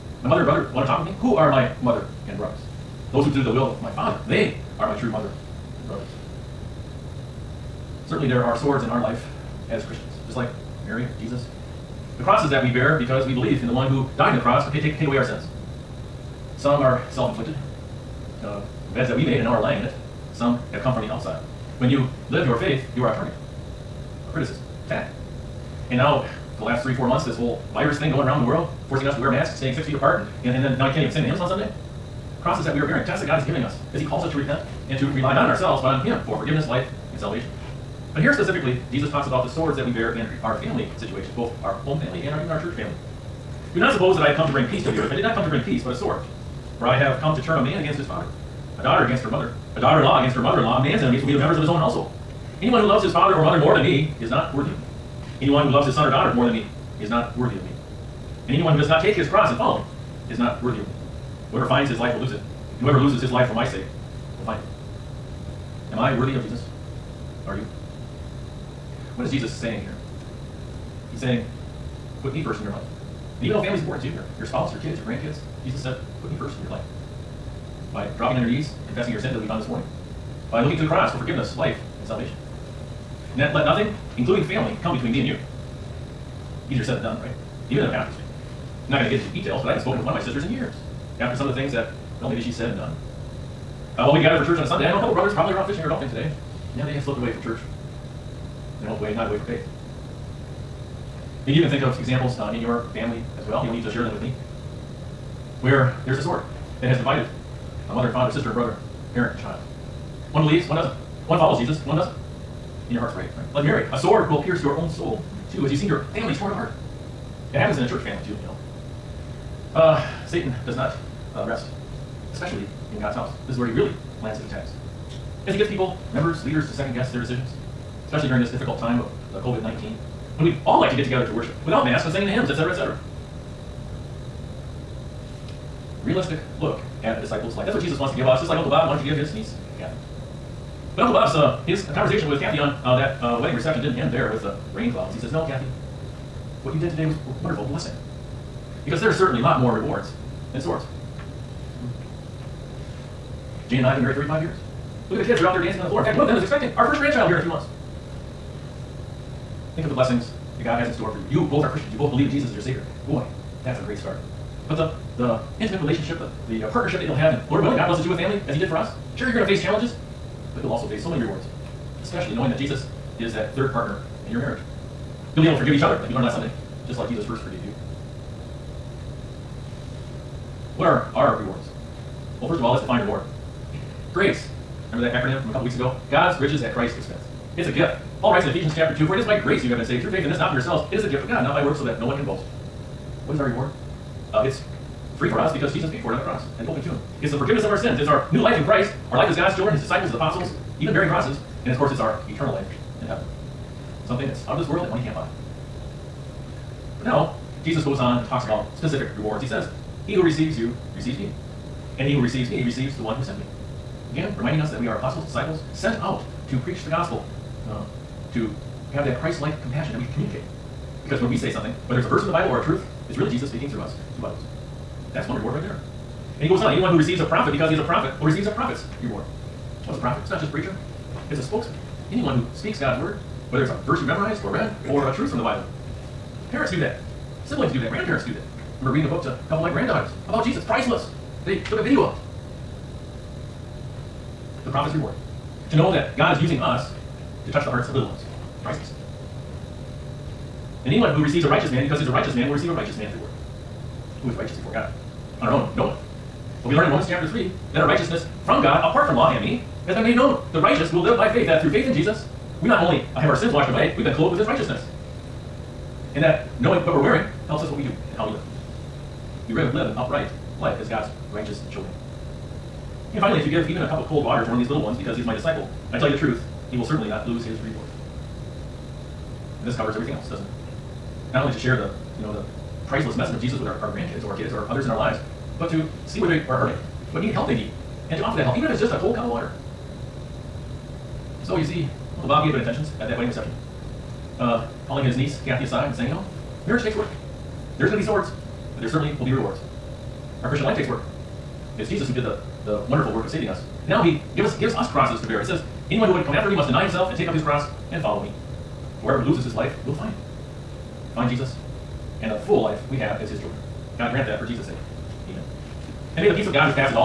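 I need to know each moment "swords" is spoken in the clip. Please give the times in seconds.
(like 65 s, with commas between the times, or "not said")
8 s, 39 s, 45 s, 106 s, 113 s, 150 s, 298 s.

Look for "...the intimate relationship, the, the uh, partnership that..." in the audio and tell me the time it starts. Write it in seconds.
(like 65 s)
165 s.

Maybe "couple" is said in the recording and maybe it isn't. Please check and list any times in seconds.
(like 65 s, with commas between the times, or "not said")
95 s, 185 s, 239 s.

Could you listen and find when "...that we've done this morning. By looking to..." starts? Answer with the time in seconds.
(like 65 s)
79 s.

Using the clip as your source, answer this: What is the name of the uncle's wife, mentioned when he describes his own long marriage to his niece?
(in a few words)
Jane.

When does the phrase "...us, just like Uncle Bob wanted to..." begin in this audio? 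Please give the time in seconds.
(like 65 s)
138 s.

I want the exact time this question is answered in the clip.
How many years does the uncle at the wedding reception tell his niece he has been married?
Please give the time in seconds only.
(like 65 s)
154 s.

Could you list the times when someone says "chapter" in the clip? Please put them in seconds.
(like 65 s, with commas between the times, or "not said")
188 s, 257 s.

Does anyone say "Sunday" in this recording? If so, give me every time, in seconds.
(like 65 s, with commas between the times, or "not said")
31 s, 94 s, 176 s.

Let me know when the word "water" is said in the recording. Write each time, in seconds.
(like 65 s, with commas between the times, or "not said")
274 s, 289 s.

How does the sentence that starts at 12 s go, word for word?
The crosses that we bear because we believe in the one who died on the cross to take, take away our sins.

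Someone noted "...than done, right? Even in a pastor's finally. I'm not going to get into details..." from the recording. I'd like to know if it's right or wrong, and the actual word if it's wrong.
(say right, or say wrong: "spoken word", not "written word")
wrong: "family", not "finally".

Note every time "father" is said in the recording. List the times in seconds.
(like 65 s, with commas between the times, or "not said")
3 s, 48 s, 53 s, 108 s.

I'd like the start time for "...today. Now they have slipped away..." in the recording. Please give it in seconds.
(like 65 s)
96 s.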